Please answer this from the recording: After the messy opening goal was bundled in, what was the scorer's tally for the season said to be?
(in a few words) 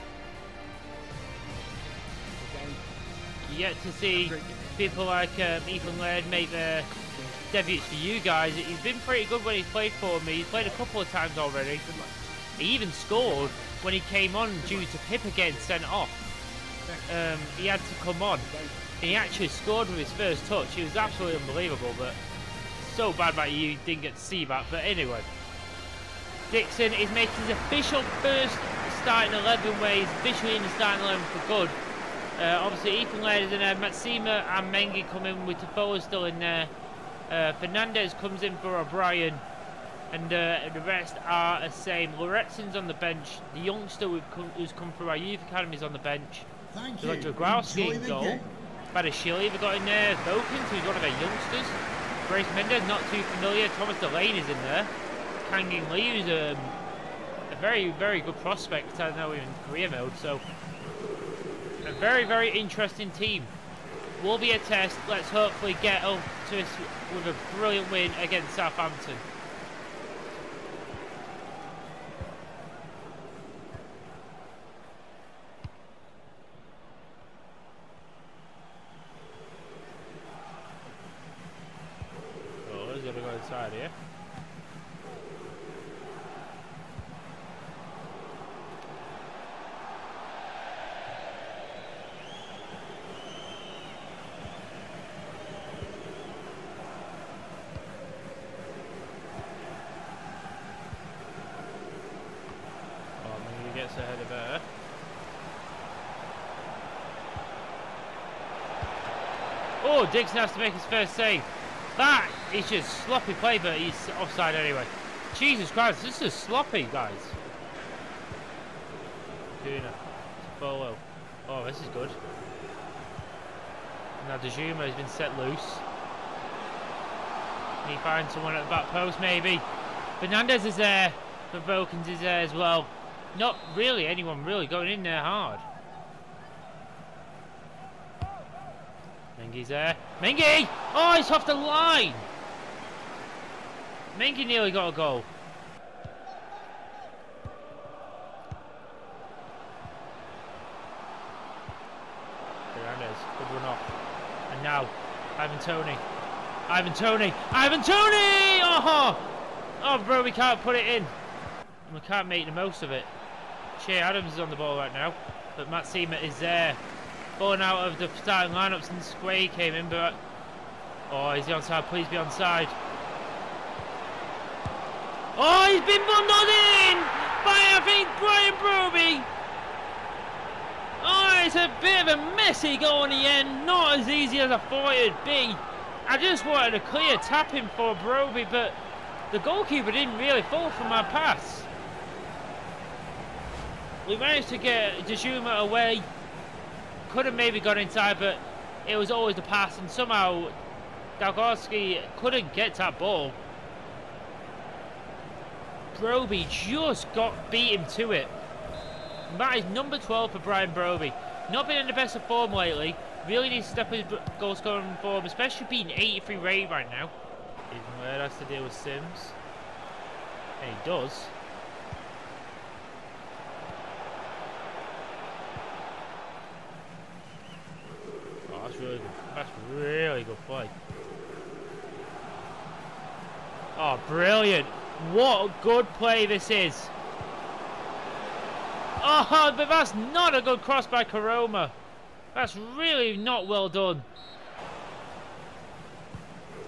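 12.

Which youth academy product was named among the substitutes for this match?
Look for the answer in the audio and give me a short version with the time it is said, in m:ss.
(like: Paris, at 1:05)
Loretson, at 0:42.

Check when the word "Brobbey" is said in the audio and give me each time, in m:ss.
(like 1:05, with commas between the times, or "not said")
2:58, 3:07, 3:25, 3:30.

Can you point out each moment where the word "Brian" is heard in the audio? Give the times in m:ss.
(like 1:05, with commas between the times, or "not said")
2:58, 3:30.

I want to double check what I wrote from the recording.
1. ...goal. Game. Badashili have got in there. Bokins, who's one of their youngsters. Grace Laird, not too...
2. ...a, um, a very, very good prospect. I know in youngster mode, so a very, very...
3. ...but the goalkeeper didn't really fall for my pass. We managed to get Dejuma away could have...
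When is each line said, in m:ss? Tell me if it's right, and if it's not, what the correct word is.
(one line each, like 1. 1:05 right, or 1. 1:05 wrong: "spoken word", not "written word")
1. 0:47 wrong: "Mendes", not "Laird"
2. 0:56 wrong: "career", not "youngster"
3. 3:08 right.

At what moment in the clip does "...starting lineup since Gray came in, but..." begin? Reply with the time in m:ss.
2:48.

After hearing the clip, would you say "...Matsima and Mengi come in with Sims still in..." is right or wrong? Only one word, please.
wrong.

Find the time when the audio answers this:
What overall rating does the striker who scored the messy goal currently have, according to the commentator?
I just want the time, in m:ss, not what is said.
3:35.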